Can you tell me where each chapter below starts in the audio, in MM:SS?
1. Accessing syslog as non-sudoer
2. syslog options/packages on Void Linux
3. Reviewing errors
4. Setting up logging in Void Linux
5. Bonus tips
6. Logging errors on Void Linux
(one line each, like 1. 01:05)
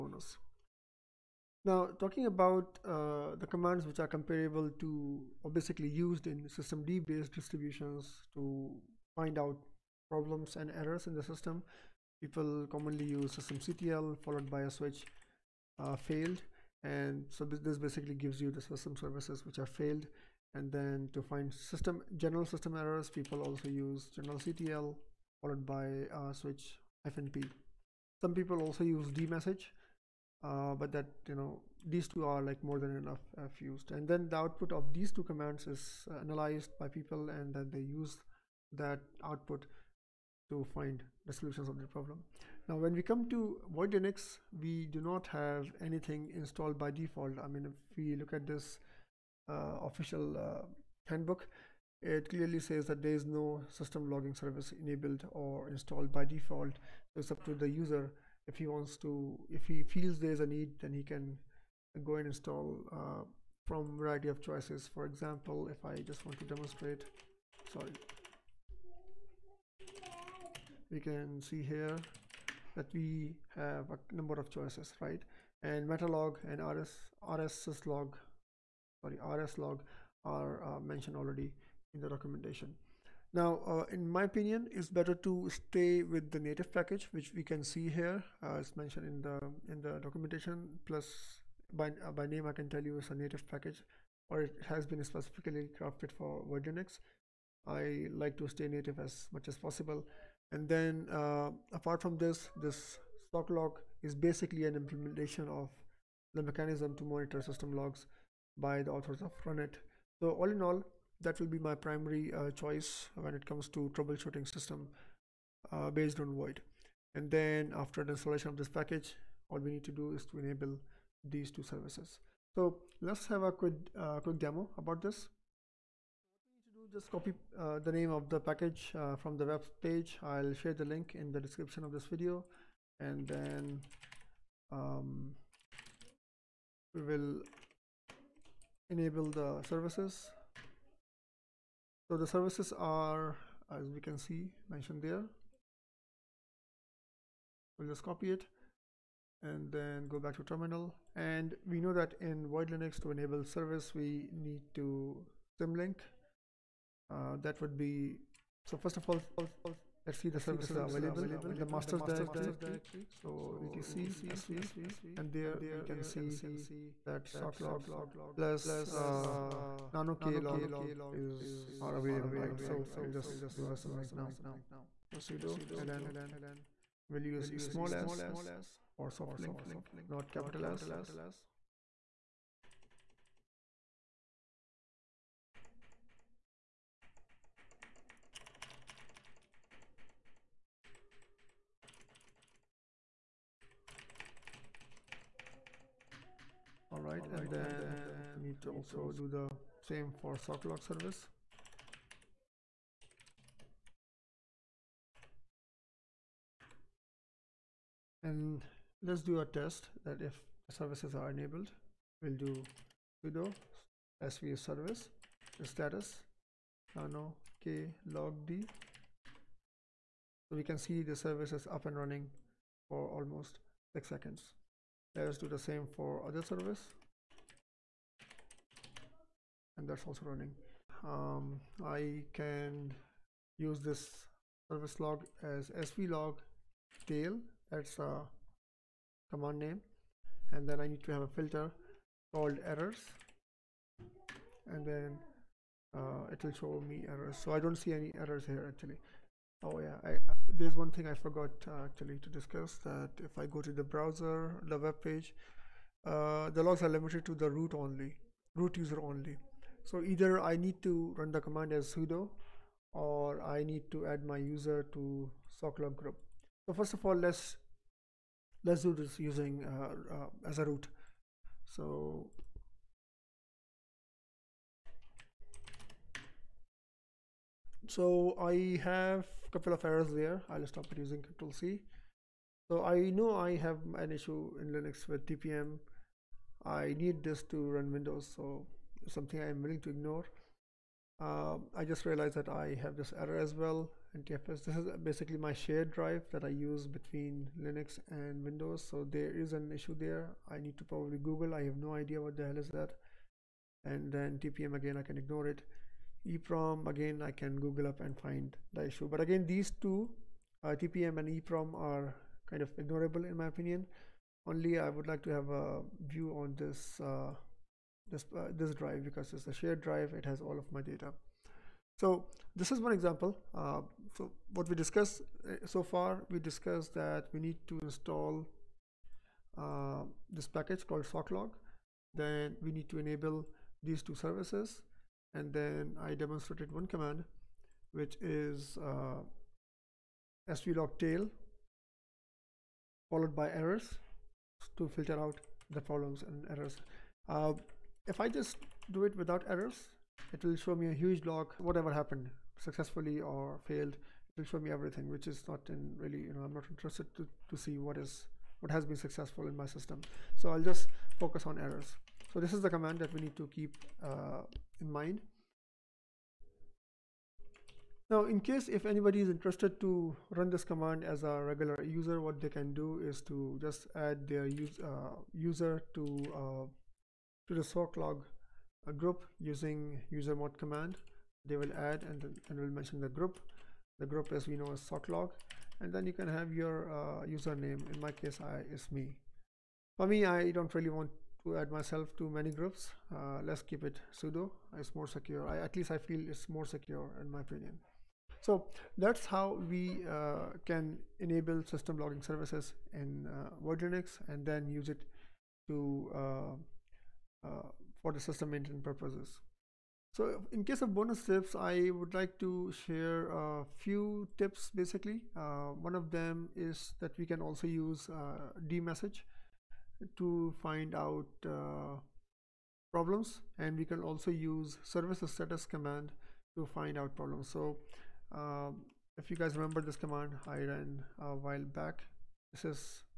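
1. 06:06
2. 01:06
3. 03:41
4. 02:01
5. 06:46
6. 00:40.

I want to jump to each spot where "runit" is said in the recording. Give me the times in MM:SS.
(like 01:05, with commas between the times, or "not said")
01:49.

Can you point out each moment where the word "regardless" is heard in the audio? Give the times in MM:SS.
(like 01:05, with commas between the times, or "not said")
not said.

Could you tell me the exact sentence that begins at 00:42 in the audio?
Now, when we come to Void Linux, we do not have anything installed by default.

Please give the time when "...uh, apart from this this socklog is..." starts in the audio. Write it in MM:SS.
01:41.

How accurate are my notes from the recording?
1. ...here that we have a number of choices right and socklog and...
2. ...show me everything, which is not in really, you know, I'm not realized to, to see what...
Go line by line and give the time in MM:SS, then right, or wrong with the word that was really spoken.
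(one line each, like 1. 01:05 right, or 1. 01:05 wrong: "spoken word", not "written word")
1. 01:11 wrong: "metalog", not "socklog"
2. 05:54 wrong: "interested", not "realized".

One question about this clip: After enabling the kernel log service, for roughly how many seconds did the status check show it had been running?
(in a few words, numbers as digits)
6 seconds.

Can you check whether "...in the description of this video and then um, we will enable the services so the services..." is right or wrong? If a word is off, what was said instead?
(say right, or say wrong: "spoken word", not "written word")
right.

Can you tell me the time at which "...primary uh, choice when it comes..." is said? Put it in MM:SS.
01:51.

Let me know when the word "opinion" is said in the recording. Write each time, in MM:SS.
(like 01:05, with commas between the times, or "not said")
01:24, 05:13, 06:37.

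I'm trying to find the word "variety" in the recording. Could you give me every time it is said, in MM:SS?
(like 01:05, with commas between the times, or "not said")
01:03.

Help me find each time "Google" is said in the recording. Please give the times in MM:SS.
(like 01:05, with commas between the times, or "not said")
05:01, 05:07.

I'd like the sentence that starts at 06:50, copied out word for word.
So in case of bonus tips, I would like to share a few tips basically.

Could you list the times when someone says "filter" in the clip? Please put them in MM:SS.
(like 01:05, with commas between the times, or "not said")
04:01, 05:44.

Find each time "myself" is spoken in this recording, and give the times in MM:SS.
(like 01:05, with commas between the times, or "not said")
06:31.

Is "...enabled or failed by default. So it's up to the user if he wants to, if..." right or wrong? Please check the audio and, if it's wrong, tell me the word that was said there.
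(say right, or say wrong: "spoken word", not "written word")
wrong: "installed", not "failed".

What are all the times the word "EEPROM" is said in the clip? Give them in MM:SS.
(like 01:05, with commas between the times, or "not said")
05:06, 05:11.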